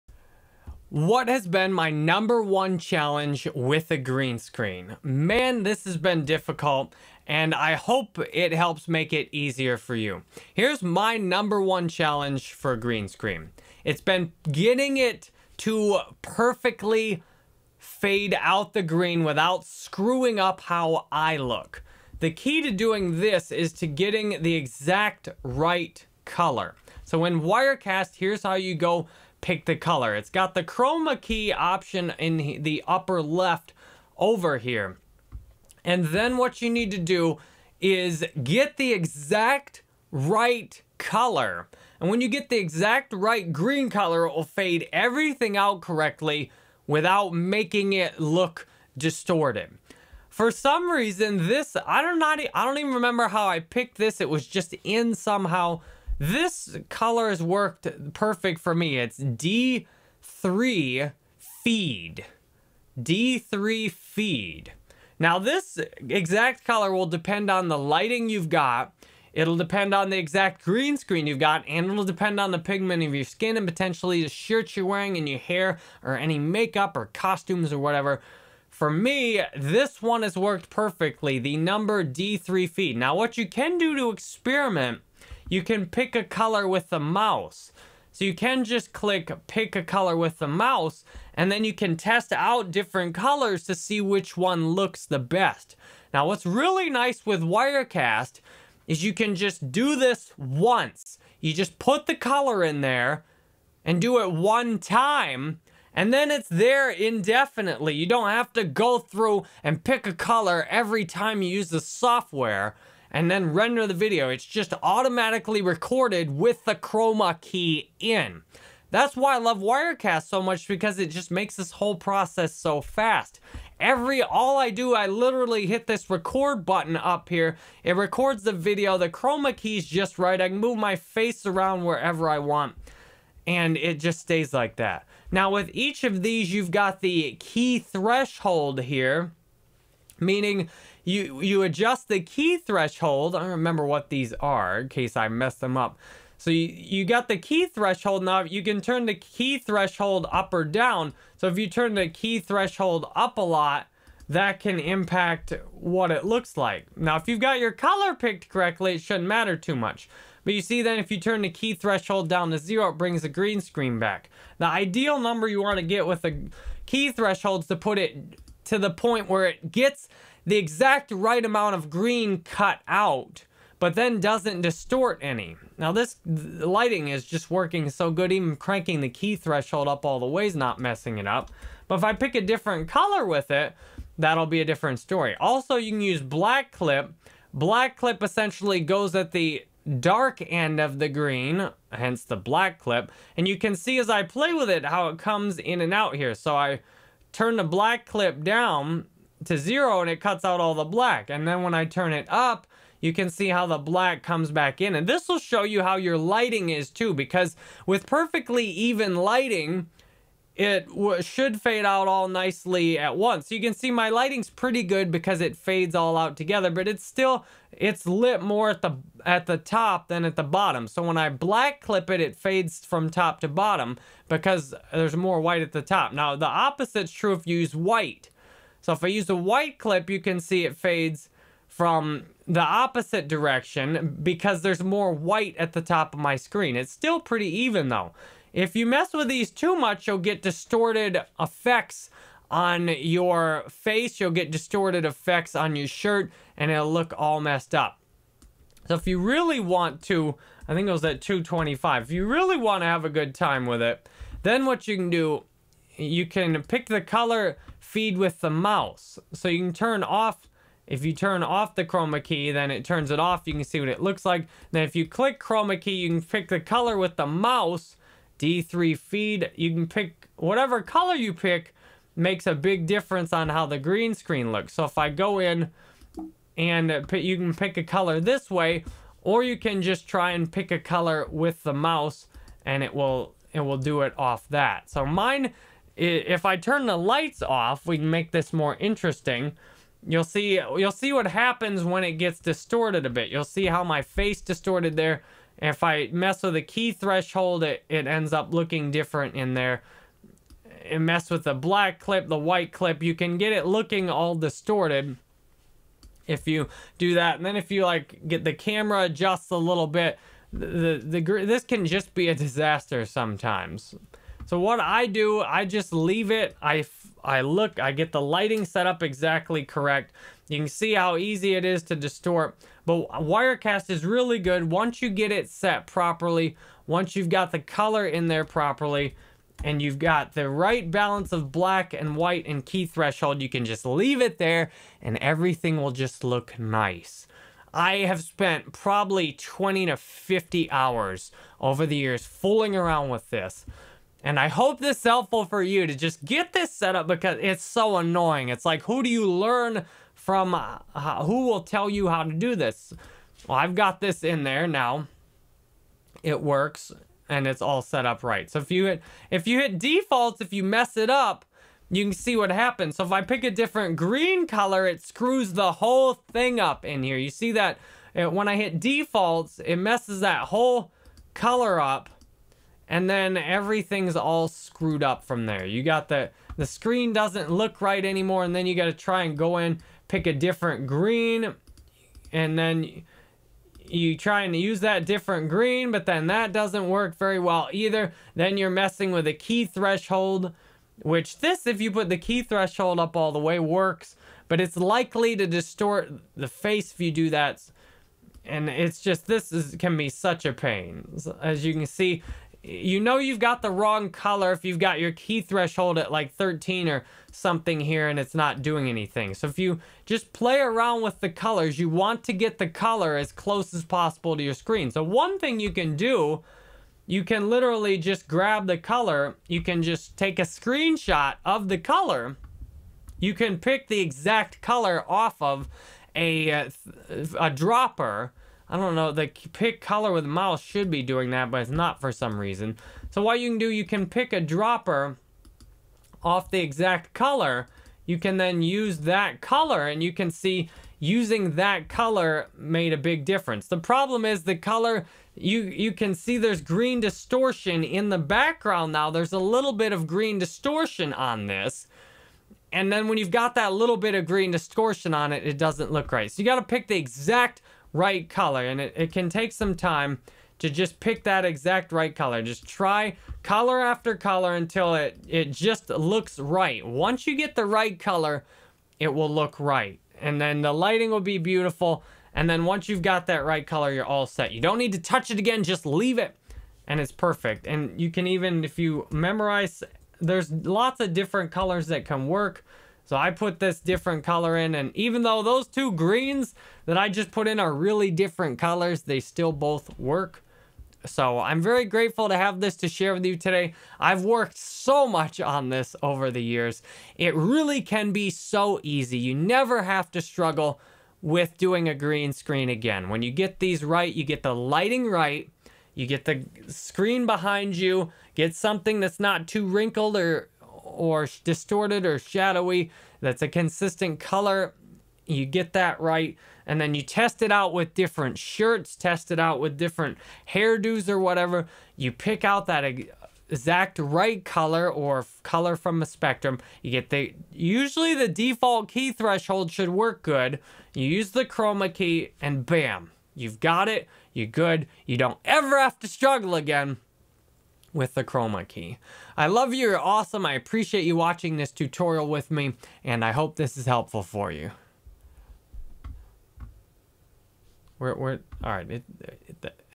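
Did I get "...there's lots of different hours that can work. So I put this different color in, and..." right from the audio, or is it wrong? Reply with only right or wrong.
wrong.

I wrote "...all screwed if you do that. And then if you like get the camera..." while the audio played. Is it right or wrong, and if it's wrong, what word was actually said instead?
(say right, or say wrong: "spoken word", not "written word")
wrong: "distorted", not "screwed".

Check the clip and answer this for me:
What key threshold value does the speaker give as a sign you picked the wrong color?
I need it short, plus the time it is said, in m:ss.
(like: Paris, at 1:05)
13, at 6:46.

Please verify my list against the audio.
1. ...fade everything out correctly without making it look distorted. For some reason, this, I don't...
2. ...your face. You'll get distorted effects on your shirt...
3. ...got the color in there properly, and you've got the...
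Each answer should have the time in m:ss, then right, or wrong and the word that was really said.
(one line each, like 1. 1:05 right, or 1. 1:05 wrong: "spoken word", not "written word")
1. 0:44 right
2. 4:02 right
3. 5:27 right.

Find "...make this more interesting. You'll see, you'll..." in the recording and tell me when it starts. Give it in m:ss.
4:48.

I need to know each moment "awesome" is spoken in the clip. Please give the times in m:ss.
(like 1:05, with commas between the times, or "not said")
8:59.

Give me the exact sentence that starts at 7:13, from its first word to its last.
So what you can do, you can pick a dropper off the exact color.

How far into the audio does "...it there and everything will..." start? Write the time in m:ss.
5:34.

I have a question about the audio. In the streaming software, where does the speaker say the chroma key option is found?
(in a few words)
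Upper left.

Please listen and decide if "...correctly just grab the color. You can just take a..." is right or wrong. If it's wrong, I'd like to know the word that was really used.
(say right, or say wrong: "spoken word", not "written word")
wrong: "literally", not "correctly".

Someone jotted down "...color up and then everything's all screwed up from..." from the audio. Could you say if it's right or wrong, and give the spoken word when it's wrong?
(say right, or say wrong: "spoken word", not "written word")
right.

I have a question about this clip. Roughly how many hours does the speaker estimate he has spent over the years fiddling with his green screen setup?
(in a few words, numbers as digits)
20 to 50 hours.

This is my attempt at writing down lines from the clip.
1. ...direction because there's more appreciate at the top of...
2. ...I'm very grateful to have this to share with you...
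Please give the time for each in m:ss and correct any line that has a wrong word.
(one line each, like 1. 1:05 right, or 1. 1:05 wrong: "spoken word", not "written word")
1. 3:53 wrong: "white", not "appreciate"
2. 8:11 right.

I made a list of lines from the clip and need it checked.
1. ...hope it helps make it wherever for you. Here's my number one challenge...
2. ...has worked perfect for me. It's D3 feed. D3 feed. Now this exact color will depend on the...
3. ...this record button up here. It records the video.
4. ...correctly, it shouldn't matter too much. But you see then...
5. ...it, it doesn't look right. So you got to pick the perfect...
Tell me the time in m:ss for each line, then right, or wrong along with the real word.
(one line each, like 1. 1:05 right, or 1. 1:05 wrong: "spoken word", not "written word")
1. 0:07 wrong: "easier", not "wherever"
2. 0:57 right
3. 2:05 right
4. 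2:38 right
5. 7:35 wrong: "exact", not "perfect".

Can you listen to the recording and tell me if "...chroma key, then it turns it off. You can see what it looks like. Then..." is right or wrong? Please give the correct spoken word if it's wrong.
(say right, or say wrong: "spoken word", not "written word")
right.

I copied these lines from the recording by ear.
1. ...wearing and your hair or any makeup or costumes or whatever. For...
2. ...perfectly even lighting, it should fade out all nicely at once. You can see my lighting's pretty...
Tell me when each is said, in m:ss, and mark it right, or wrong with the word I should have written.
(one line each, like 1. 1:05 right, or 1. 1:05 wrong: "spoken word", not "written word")
1. 1:14 right
2. 3:28 right.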